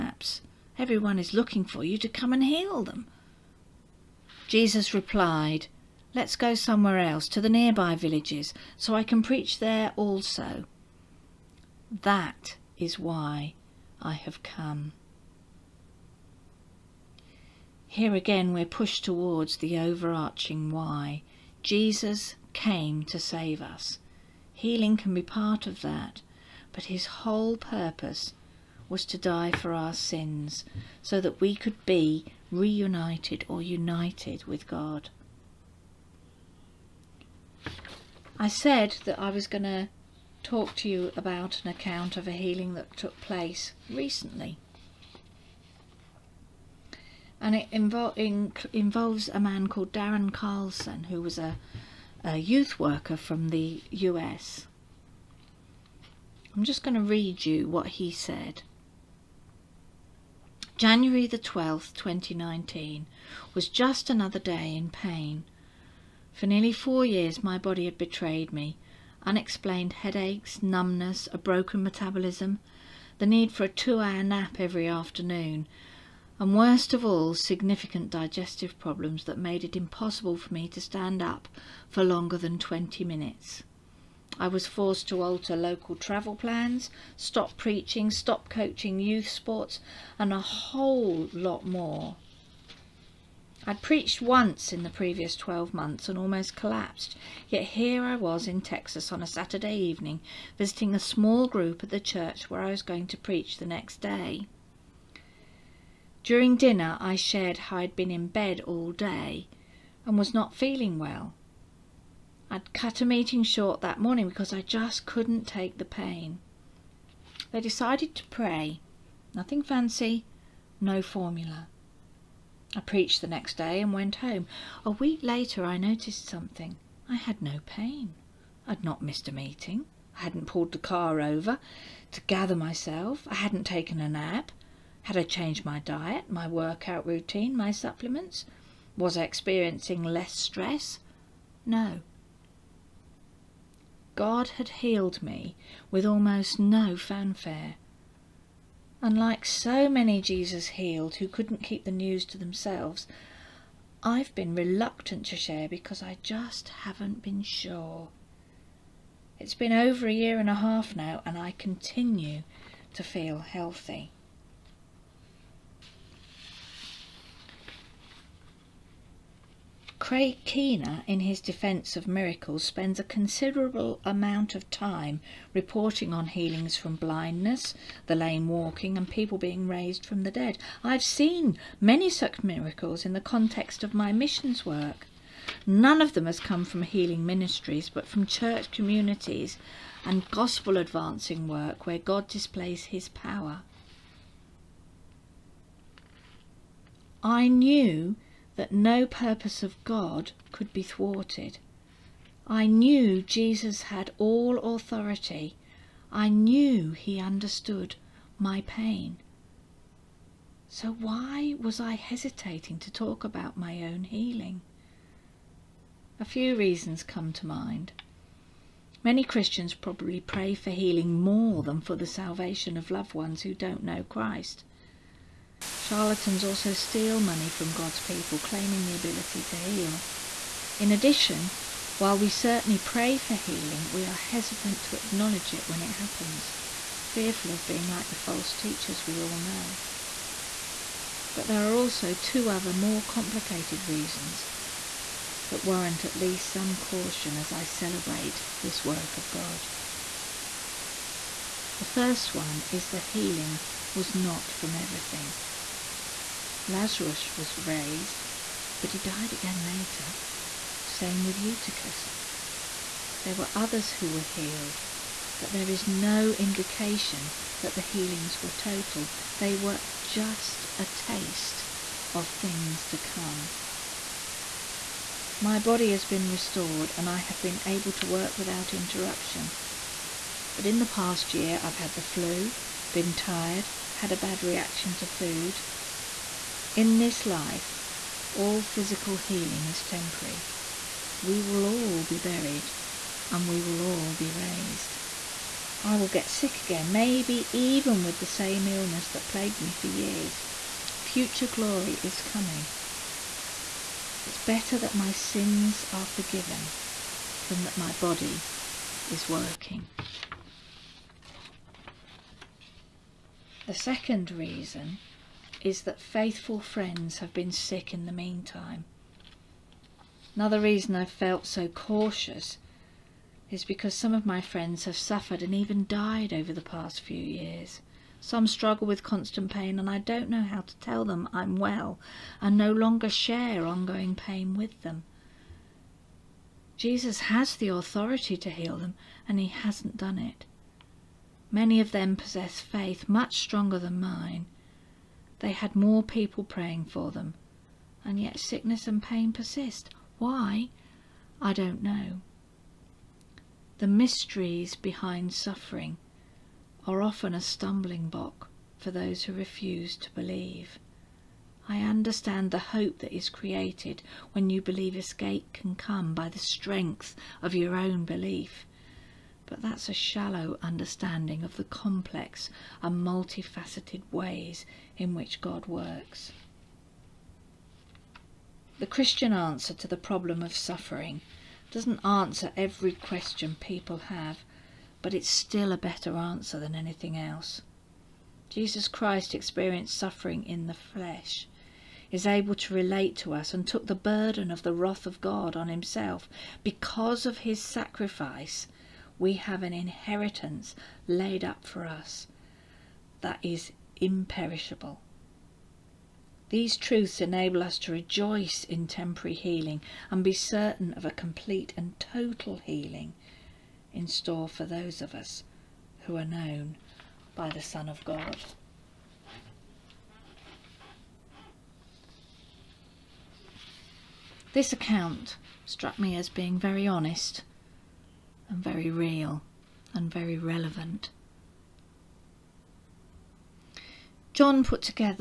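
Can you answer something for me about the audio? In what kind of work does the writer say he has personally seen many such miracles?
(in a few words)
missions work.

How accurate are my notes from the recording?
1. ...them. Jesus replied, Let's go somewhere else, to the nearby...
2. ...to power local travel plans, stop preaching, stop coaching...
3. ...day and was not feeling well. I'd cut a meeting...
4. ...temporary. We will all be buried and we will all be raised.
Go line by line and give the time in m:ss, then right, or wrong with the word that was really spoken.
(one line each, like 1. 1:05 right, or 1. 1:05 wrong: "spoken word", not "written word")
1. 0:02 right
2. 1:25 wrong: "alter", not "power"
3. 1:48 right
4. 4:49 right.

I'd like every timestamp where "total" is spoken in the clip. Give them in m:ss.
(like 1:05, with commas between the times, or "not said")
4:28, 6:51.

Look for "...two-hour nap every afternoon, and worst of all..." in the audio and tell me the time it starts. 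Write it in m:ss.
1:13.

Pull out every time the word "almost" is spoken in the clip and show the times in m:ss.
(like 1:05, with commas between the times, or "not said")
1:36, 2:26.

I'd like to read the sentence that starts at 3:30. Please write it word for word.
So why was I hesitating to talk about my own healing?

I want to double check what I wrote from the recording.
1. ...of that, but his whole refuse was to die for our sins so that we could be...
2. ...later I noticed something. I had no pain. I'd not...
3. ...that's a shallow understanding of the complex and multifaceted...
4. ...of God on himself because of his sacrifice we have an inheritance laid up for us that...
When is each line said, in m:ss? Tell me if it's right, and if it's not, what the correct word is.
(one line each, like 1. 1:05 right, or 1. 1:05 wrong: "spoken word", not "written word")
1. 0:25 wrong: "purpose", not "refuse"
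2. 2:05 right
3. 6:09 right
4. 6:35 right.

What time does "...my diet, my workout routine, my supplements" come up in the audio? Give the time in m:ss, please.
2:15.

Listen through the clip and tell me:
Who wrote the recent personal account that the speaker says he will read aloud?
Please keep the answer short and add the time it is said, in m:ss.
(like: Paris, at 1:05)
Darren Carlson, at 0:49.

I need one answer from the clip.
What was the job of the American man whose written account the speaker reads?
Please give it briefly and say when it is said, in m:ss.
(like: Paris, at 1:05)
youth worker, at 0:52.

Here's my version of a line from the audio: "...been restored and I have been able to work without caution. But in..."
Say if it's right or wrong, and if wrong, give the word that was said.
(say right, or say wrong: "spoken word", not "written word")
wrong: "interruption", not "caution".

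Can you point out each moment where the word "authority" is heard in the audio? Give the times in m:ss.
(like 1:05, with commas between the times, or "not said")
3:24, 5:37.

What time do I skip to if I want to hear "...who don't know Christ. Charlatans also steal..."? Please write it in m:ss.
3:43.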